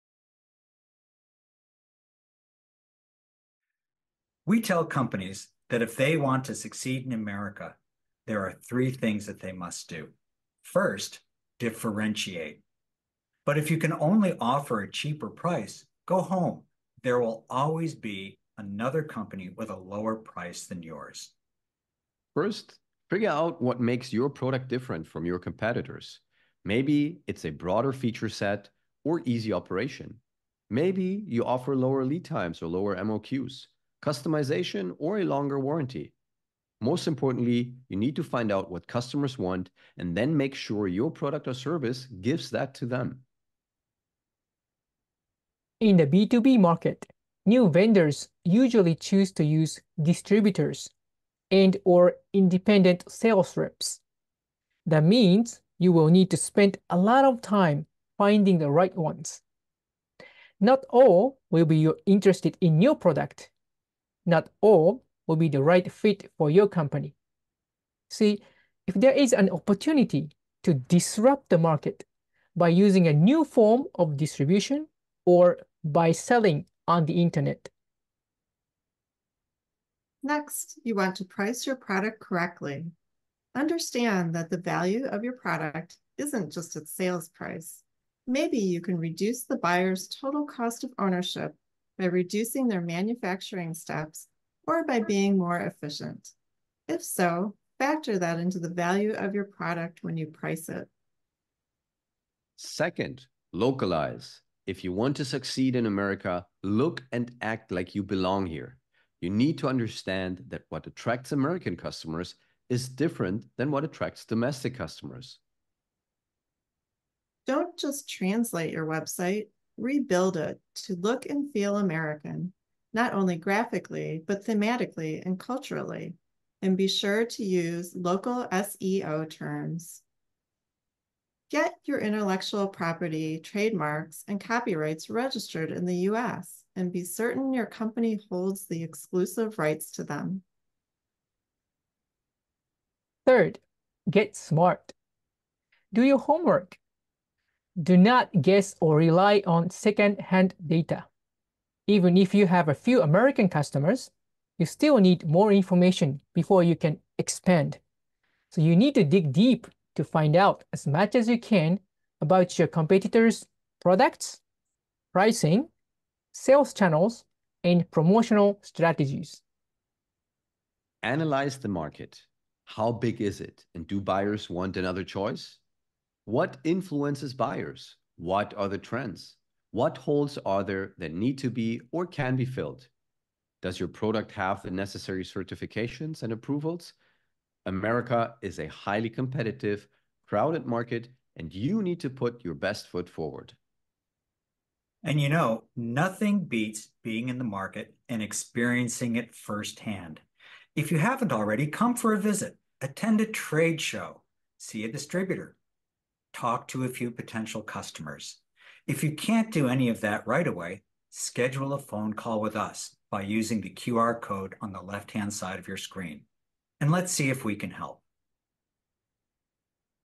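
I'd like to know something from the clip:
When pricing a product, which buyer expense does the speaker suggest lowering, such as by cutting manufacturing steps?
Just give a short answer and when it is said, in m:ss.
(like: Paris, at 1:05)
total cost of ownership, at 1:30.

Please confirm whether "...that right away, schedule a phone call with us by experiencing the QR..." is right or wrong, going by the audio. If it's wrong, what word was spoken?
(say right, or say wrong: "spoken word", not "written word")
wrong: "using", not "experiencing".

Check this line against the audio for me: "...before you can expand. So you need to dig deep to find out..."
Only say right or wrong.
right.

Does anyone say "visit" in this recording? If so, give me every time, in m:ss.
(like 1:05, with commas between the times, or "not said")
3:22.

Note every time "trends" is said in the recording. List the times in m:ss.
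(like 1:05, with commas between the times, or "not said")
2:58.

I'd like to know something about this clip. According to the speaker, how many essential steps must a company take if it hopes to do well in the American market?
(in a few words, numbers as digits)
3.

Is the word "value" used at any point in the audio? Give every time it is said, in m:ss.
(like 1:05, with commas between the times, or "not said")
1:24, 1:38.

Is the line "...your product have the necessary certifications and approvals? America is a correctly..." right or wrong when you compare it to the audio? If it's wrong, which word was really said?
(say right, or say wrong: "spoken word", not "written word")
wrong: "highly", not "correctly".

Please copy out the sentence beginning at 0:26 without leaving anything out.
Maybe it's a broader feature set or easy operation.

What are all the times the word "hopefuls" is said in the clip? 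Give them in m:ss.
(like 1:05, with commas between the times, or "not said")
not said.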